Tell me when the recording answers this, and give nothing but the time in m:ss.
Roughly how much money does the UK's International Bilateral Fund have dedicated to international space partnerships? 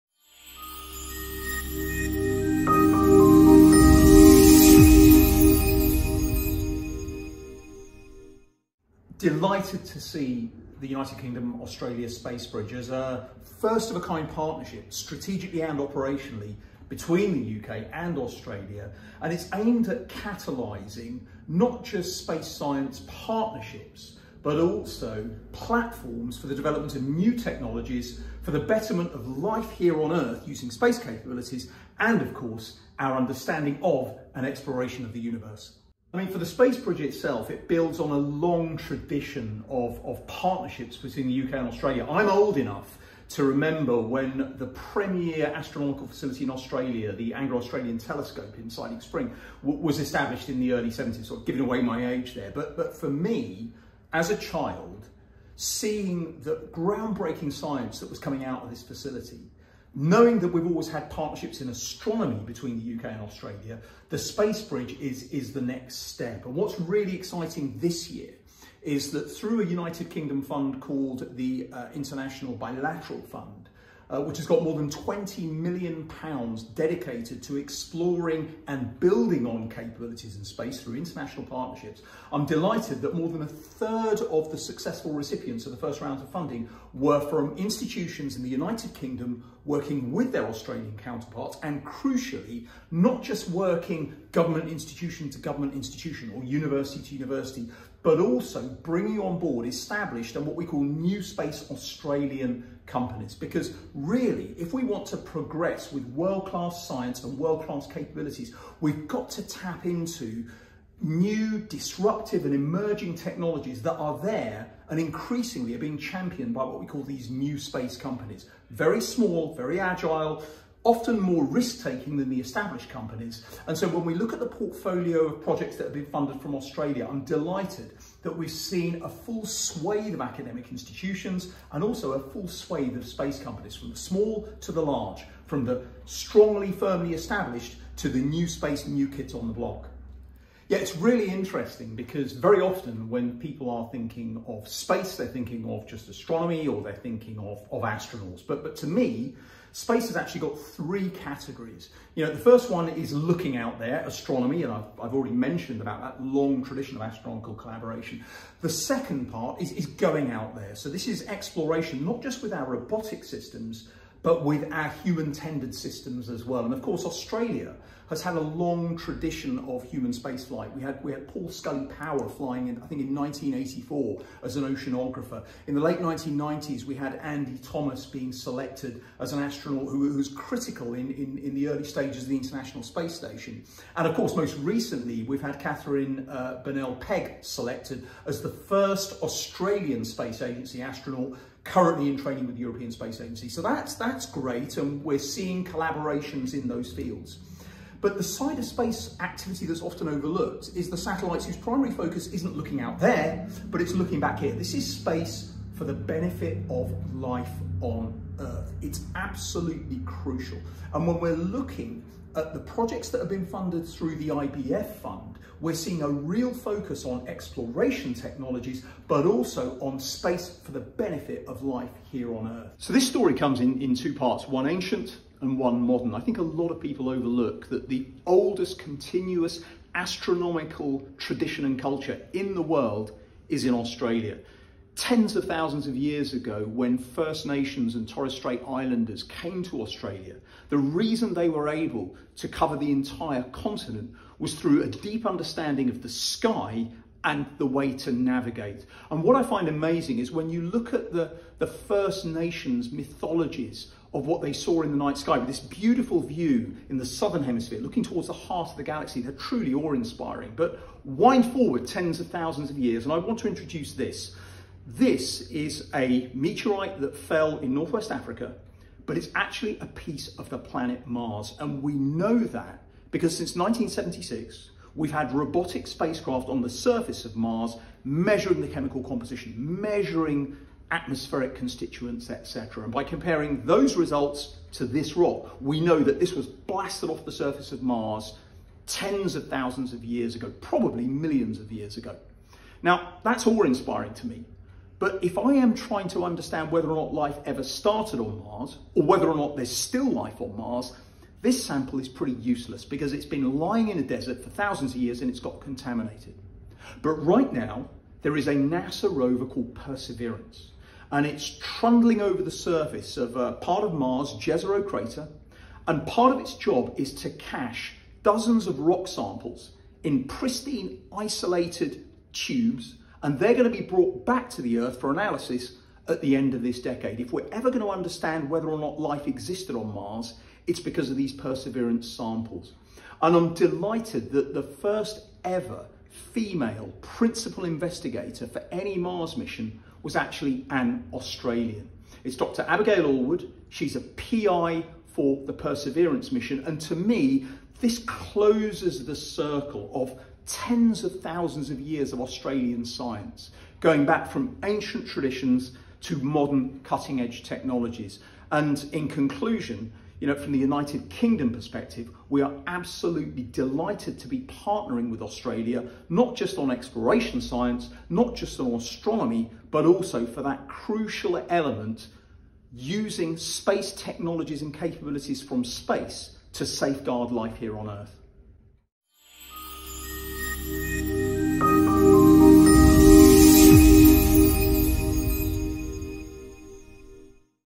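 1:14.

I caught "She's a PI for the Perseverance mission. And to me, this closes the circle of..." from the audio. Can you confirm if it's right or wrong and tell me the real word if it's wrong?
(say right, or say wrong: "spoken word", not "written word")
right.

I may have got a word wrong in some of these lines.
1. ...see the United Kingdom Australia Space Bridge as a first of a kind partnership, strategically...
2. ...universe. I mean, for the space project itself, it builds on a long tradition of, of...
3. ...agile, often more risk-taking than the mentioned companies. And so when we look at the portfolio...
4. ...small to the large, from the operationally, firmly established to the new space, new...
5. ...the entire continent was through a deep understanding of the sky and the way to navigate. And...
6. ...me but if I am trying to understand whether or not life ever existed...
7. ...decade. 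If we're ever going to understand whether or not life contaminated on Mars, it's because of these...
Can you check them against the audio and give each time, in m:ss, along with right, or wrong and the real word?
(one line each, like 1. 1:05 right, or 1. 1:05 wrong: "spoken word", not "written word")
1. 0:10 right
2. 0:35 right
3. 1:59 wrong: "established", not "mentioned"
4. 2:13 wrong: "strongly", not "operationally"
5. 4:02 right
6. 4:54 wrong: "started", not "existed"
7. 5:26 wrong: "existed", not "contaminated".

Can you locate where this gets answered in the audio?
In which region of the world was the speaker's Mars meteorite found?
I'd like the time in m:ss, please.
4:27.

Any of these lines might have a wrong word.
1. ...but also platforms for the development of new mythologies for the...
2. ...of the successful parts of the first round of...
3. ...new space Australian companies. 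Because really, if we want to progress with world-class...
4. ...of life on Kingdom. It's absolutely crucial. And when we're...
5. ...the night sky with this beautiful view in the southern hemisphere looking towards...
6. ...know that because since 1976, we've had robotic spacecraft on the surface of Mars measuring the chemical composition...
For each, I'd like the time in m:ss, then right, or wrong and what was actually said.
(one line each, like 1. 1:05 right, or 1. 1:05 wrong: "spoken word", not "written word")
1. 0:24 wrong: "technologies", not "mythologies"
2. 1:24 wrong: "recipients", not "parts"
3. 1:40 right
4. 3:26 wrong: "Earth", not "Kingdom"
5. 4:14 right
6. 4:31 right.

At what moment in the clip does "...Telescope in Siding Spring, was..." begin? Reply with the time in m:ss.
0:47.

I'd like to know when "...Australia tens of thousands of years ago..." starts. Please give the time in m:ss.
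3:53.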